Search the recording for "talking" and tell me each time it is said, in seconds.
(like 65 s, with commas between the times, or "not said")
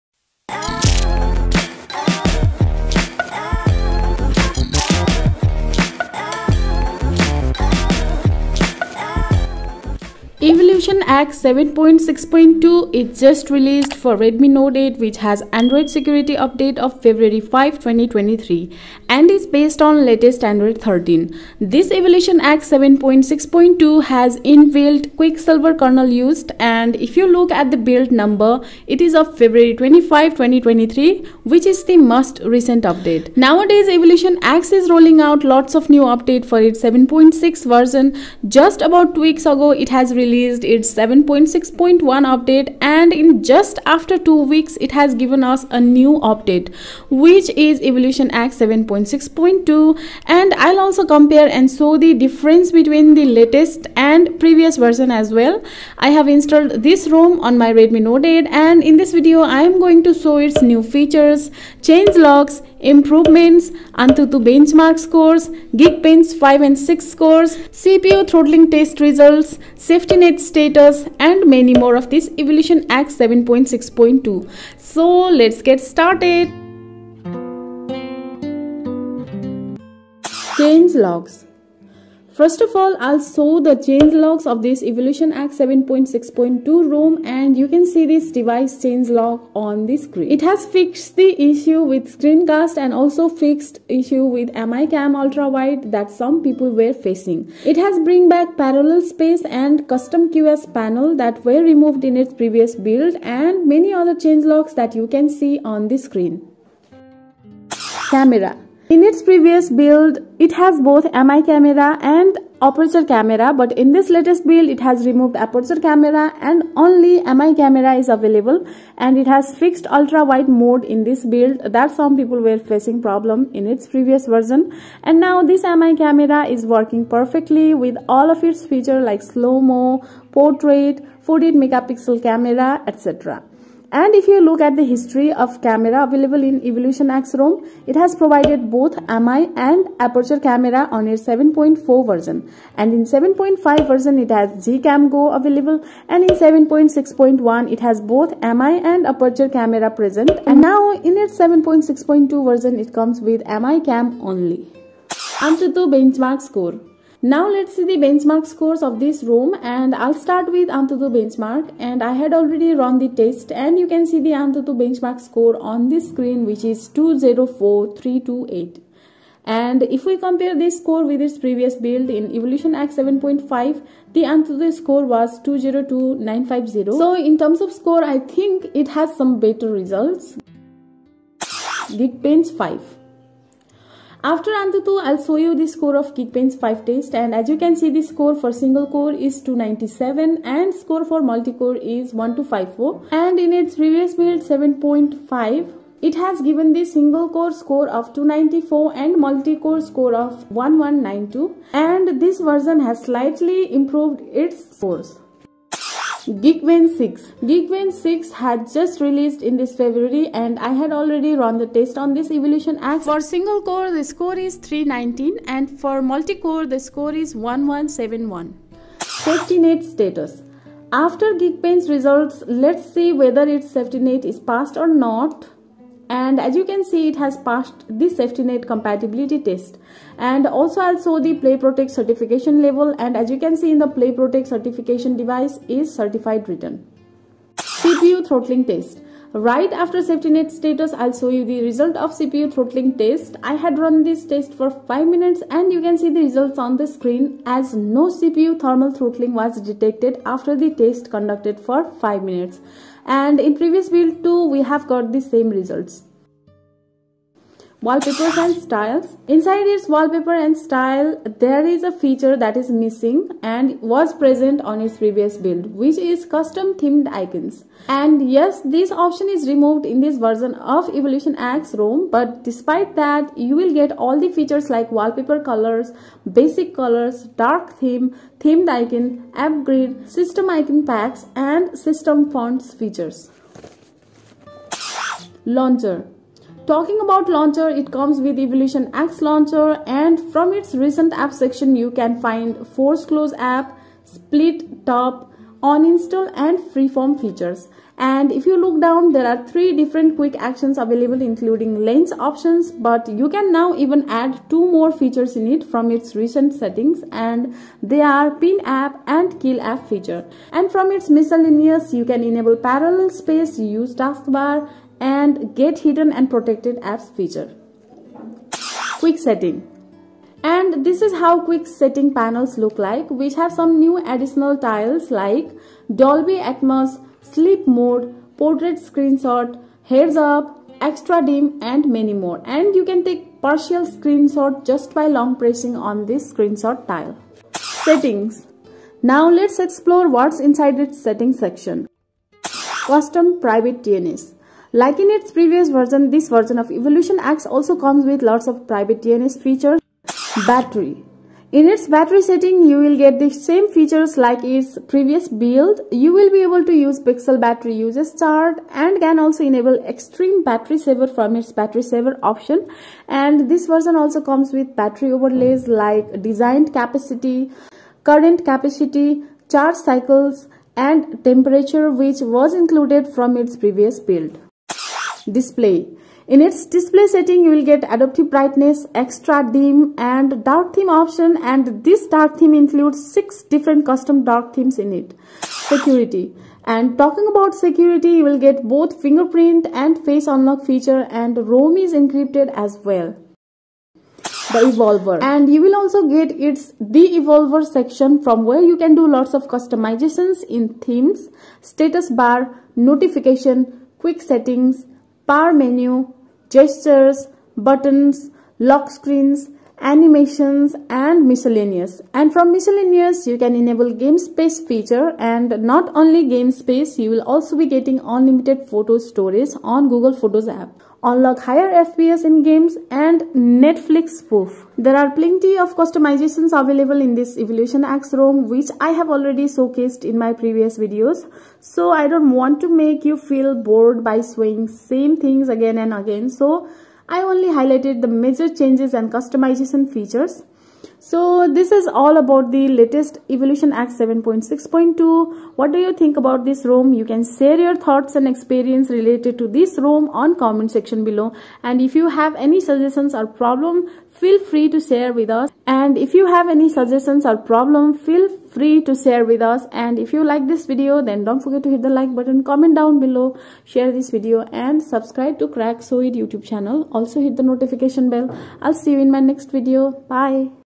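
286 s, 386 s.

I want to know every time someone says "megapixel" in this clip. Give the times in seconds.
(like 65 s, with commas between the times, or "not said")
131 s.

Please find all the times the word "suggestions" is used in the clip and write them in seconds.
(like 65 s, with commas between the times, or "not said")
452 s, 456 s.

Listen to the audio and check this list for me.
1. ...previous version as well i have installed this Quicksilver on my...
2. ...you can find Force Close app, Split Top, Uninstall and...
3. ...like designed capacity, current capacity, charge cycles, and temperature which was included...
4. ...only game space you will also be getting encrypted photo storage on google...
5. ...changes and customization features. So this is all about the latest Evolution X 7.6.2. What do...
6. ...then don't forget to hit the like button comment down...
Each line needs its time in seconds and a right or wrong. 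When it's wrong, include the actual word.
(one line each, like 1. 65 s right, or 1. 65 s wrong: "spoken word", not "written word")
1. 54 s wrong: "ROM", not "Quicksilver"
2. 291 s right
3. 365 s right
4. 415 s wrong: "unlimited", not "encrypted"
5. 438 s right
6. 461 s right.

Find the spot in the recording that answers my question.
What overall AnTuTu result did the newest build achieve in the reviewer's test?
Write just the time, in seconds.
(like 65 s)
166 s.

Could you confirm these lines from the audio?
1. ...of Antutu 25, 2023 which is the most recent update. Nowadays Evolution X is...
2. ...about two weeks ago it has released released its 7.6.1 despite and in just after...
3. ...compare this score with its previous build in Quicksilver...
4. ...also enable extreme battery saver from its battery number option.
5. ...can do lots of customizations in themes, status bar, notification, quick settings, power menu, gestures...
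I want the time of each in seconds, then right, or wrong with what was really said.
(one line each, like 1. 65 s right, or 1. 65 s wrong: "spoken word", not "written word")
1. 29 s wrong: "February", not "Antutu"
2. 38 s wrong: "update", not "despite"
3. 170 s wrong: "Evolution", not "Quicksilver"
4. 359 s wrong: "saver", not "number"
5. 398 s right.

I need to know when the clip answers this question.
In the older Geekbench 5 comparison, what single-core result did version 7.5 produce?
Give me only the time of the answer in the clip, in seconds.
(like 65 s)
198 s.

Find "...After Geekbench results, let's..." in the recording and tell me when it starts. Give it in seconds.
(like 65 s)
220 s.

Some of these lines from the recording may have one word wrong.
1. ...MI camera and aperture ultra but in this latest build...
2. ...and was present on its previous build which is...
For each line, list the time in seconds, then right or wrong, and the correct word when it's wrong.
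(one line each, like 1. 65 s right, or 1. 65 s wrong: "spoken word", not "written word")
1. 111 s wrong: "camera", not "ultra"
2. 263 s right.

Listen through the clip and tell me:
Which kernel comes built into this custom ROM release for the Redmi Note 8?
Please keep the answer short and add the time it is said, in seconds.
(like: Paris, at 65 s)
Quicksilver, at 25 s.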